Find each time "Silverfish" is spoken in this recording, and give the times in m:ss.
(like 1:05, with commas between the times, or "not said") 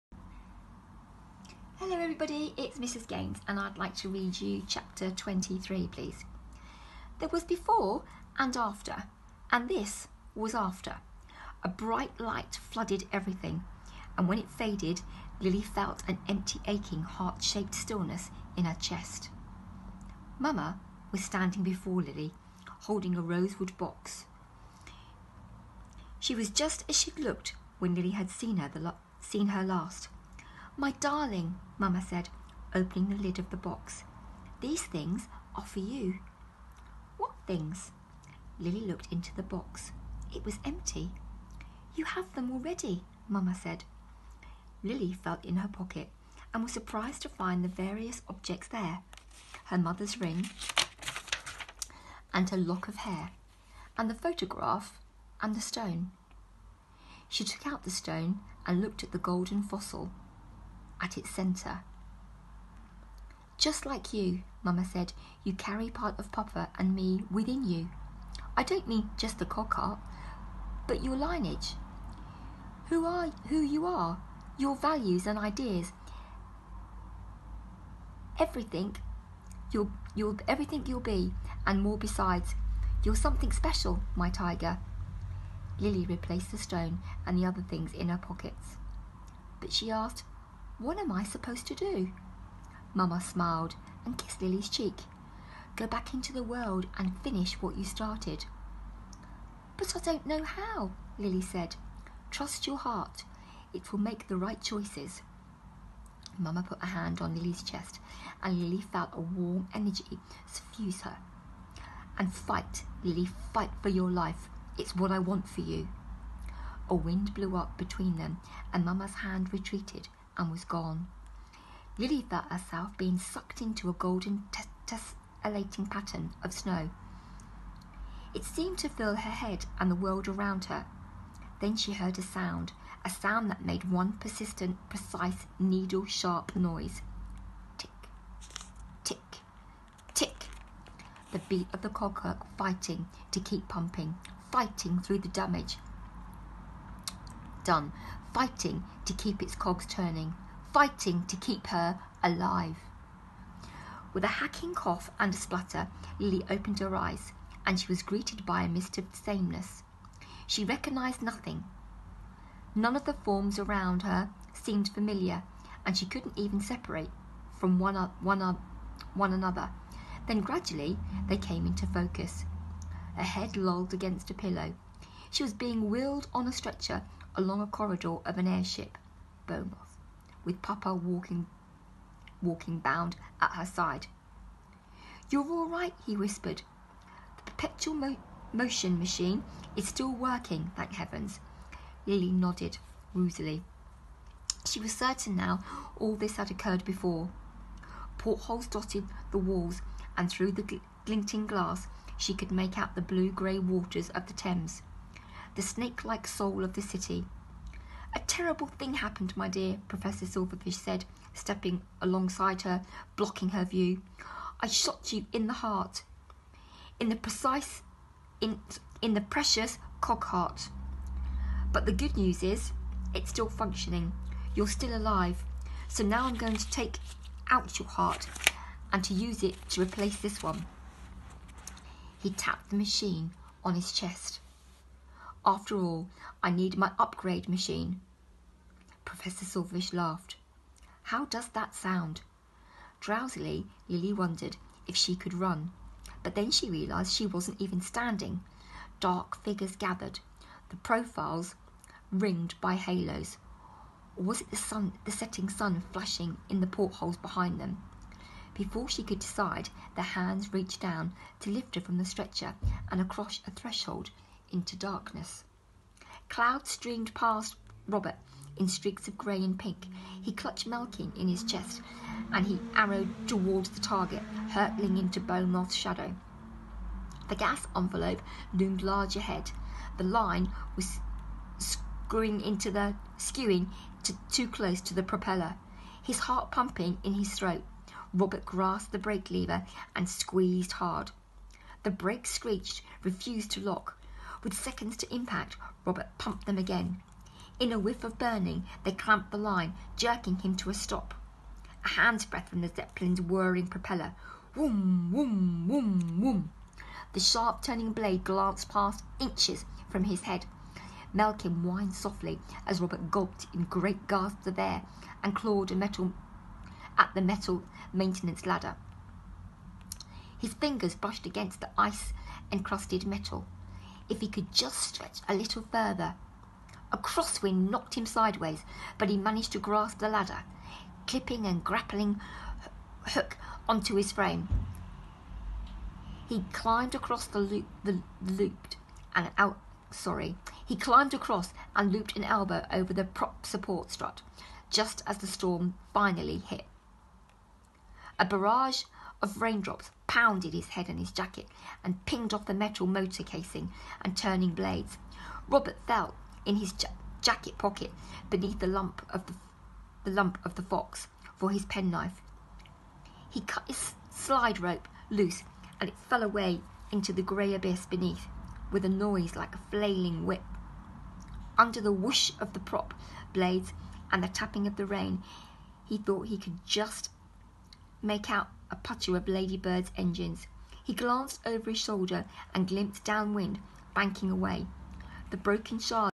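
3:30, 3:59.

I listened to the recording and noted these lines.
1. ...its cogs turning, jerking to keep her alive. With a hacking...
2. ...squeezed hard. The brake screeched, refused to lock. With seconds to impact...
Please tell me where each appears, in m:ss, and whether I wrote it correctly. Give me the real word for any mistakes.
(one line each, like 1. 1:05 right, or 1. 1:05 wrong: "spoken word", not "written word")
1. 2:29 wrong: "fighting", not "jerking"
2. 4:50 right.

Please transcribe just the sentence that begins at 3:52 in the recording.
He tapped the machine on his chest.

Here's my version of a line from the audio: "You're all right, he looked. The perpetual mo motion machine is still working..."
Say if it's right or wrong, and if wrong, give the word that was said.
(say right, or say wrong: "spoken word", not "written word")
wrong: "whispered", not "looked".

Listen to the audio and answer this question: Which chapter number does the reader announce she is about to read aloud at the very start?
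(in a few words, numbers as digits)
23.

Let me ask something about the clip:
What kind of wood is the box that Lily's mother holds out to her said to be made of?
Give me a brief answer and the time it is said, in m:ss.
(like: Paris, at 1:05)
Rosewood, at 0:23.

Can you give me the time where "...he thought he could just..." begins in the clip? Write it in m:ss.
6:15.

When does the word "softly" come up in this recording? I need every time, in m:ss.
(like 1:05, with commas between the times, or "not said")
5:11.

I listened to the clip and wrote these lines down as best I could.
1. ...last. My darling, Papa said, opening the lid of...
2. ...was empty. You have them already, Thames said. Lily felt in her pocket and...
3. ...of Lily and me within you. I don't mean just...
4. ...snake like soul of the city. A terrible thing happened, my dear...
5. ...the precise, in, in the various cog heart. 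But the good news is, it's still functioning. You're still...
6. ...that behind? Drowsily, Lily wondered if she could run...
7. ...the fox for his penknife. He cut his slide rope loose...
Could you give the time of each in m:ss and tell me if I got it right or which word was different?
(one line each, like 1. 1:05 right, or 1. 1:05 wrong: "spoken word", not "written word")
1. 0:29 wrong: "Mamma", not "Papa"
2. 0:40 wrong: "Mamma", not "Thames"
3. 1:06 wrong: "Papa", not "Lily"
4. 3:25 right
5. 3:37 wrong: "precious", not "various"
6. 4:01 wrong: "sound", not "behind"
7. 6:00 right.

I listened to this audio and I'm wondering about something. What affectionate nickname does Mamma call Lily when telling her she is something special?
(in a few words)
Tiger.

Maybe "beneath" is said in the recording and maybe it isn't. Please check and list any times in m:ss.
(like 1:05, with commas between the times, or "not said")
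5:58, 6:07.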